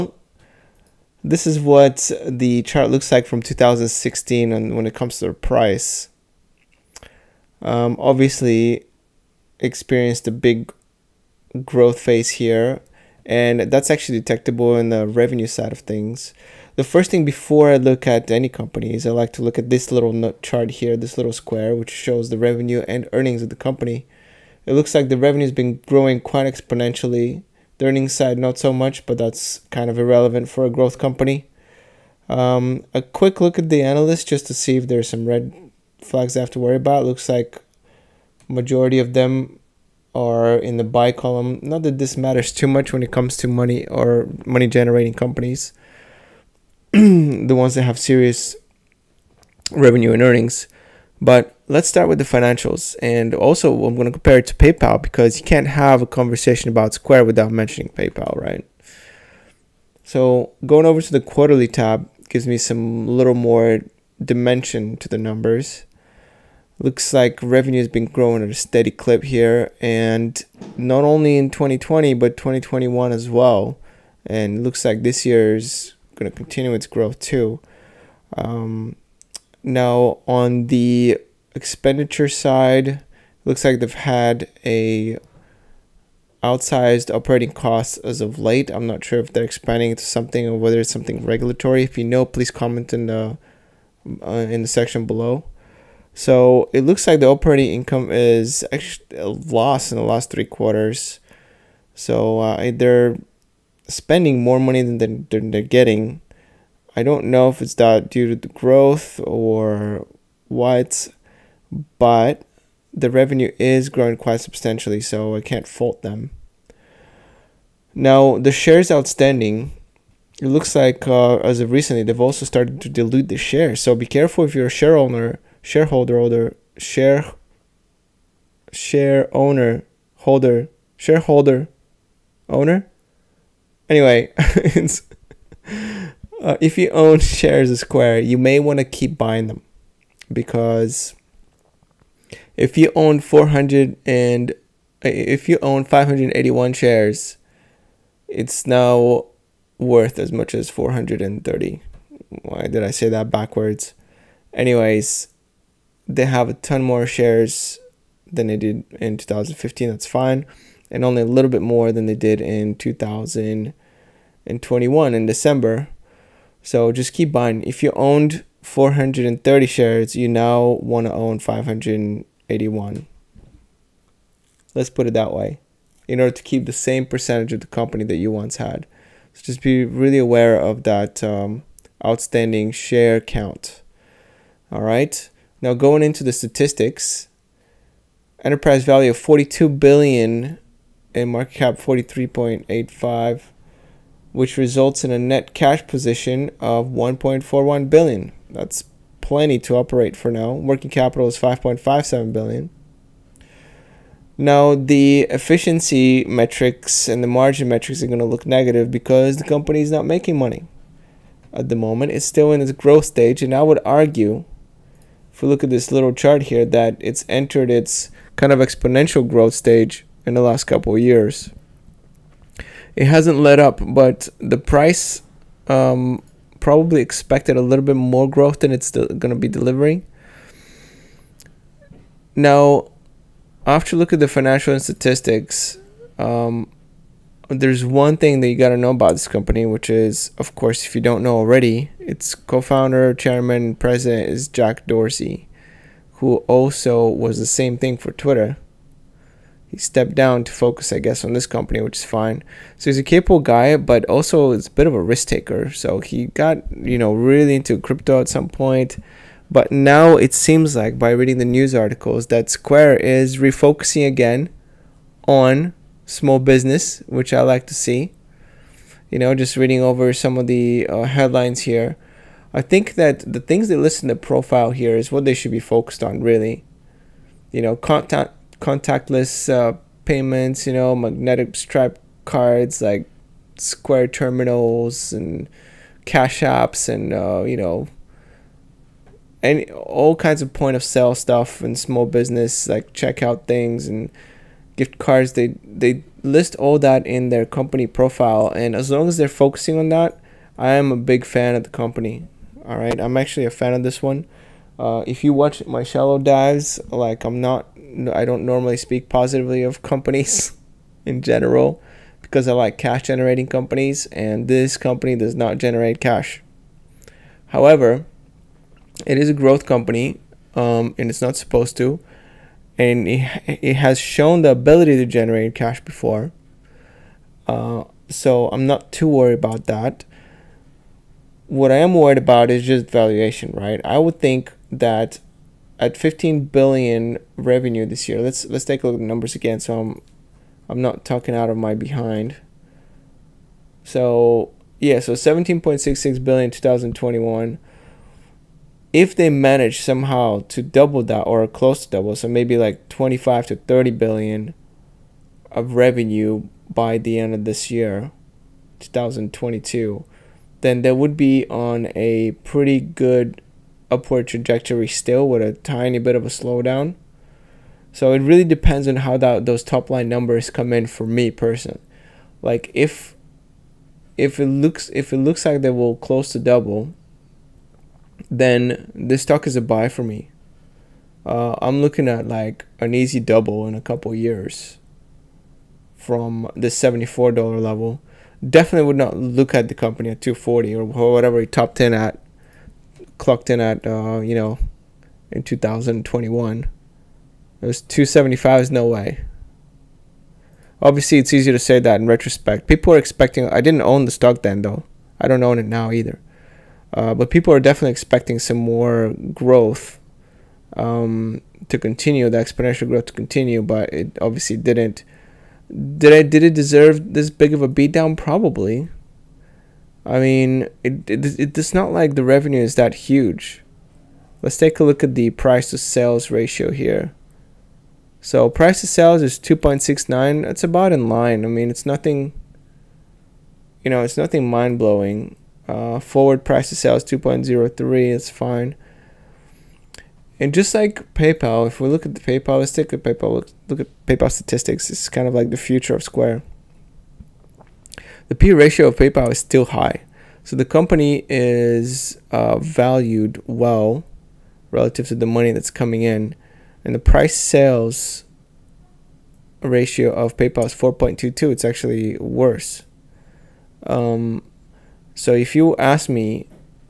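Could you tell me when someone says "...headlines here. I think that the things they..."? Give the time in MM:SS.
04:31.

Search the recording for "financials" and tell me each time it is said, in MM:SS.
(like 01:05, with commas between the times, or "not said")
00:52, 03:54.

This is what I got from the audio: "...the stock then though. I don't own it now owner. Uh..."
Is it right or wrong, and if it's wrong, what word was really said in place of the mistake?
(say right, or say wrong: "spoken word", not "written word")
wrong: "either", not "owner".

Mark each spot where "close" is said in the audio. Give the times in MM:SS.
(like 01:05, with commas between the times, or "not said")
05:51, 06:15.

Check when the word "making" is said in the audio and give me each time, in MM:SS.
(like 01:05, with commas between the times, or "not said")
03:30.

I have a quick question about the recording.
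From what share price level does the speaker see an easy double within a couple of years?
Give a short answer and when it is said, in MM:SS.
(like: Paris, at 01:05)
$74, at 06:26.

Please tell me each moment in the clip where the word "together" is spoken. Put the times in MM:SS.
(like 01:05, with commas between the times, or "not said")
not said.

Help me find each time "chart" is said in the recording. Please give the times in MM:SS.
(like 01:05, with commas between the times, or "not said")
00:02, 00:20, 03:36.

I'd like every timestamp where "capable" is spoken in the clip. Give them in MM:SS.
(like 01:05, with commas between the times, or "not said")
04:13.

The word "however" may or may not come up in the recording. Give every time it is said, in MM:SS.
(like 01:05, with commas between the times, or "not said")
05:17.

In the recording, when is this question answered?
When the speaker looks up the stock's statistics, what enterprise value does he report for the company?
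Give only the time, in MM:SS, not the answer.
03:09.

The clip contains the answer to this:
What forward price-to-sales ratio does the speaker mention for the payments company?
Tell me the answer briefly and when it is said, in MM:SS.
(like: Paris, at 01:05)
2.03, at 07:17.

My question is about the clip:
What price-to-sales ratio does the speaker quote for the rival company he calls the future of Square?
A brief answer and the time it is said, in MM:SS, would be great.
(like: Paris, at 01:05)
4.22, at 07:40.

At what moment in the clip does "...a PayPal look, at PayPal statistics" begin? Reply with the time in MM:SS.
07:22.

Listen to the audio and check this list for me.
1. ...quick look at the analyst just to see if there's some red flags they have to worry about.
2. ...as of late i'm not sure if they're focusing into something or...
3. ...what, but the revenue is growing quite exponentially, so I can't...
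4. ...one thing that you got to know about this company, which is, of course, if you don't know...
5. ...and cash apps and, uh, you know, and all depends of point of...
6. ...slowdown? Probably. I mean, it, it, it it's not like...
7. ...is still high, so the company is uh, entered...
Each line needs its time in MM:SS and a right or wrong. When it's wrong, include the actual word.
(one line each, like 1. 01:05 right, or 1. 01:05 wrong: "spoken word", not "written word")
1. 00:33 right
2. 01:27 wrong: "expanding", not "focusing"
3. 01:50 wrong: "substantially", not "exponentially"
4. 03:57 right
5. 04:45 wrong: "kinds", not "depends"
6. 06:57 wrong: "beatdown", not "slowdown"
7. 07:29 wrong: "valued", not "entered".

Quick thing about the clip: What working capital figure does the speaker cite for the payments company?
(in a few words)
5.57 billion.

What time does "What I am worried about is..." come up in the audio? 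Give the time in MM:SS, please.
05:31.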